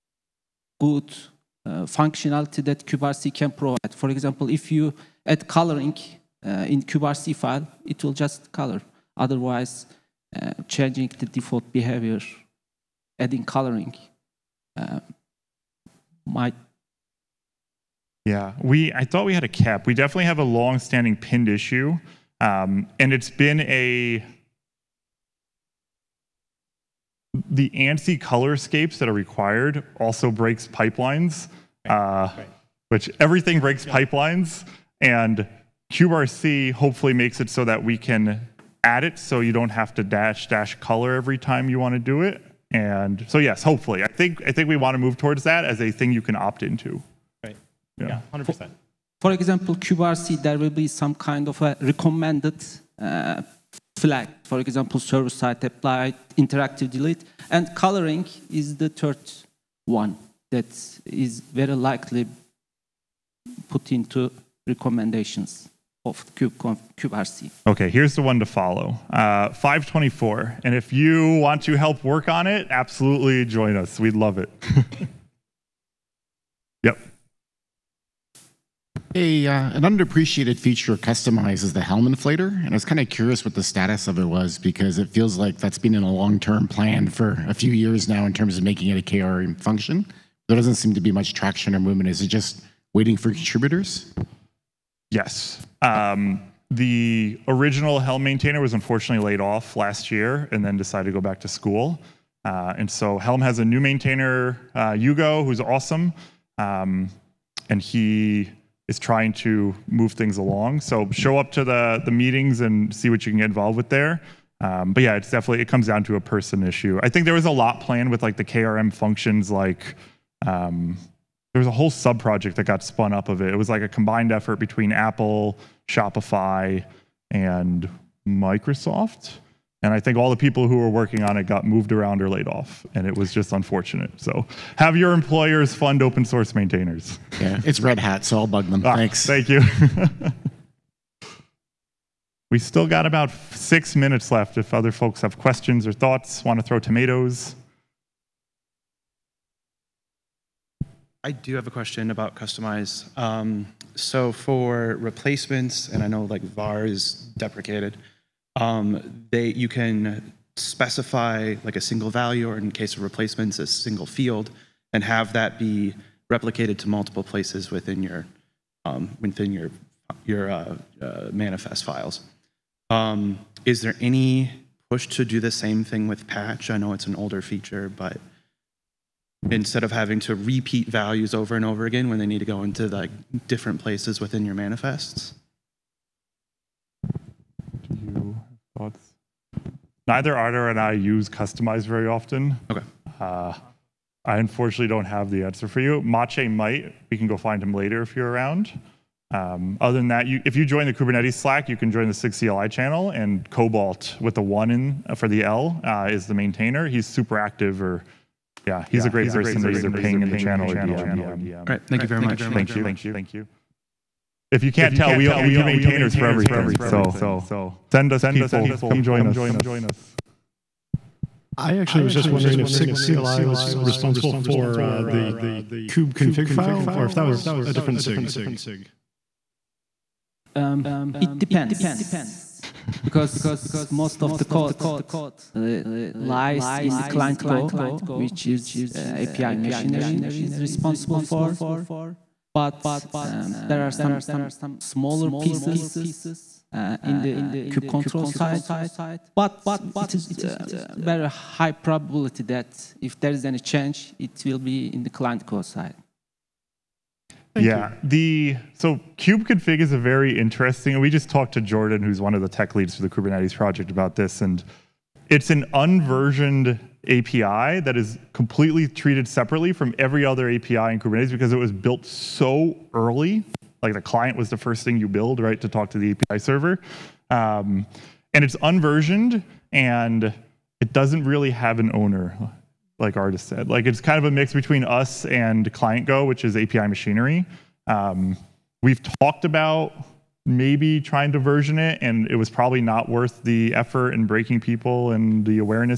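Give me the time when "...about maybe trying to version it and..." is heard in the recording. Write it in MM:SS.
04:49.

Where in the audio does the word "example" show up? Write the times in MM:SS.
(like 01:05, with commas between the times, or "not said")
00:04, 00:49, 00:54.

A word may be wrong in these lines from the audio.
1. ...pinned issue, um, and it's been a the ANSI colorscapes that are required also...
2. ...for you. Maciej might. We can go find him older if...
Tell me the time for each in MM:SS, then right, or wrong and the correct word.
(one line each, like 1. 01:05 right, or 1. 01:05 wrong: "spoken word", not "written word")
1. 00:21 right
2. 03:15 wrong: "later", not "older".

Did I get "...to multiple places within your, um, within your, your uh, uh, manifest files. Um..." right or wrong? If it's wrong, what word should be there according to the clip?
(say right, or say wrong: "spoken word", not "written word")
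right.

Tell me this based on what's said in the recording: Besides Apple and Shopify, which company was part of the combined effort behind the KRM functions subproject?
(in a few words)
Microsoft.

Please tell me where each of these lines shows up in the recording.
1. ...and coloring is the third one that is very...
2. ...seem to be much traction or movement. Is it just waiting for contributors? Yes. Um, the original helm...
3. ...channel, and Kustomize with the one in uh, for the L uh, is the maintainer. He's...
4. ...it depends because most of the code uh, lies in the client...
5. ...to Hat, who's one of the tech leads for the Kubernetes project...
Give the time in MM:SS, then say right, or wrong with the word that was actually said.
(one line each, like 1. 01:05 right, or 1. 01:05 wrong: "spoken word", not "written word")
1. 00:57 right
2. 01:30 right
3. 03:22 wrong: "Cobalt", not "Kustomize"
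4. 03:51 right
5. 04:21 wrong: "Jordan", not "Hat".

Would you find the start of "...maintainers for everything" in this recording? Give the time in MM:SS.
03:35.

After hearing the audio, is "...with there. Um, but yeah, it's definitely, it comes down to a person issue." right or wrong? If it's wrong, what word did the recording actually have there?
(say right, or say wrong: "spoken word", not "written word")
right.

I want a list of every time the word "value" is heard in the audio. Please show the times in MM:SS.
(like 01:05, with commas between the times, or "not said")
02:42, 03:00.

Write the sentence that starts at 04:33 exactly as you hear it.
Like the client was the first thing you build, right, to talk to the API server.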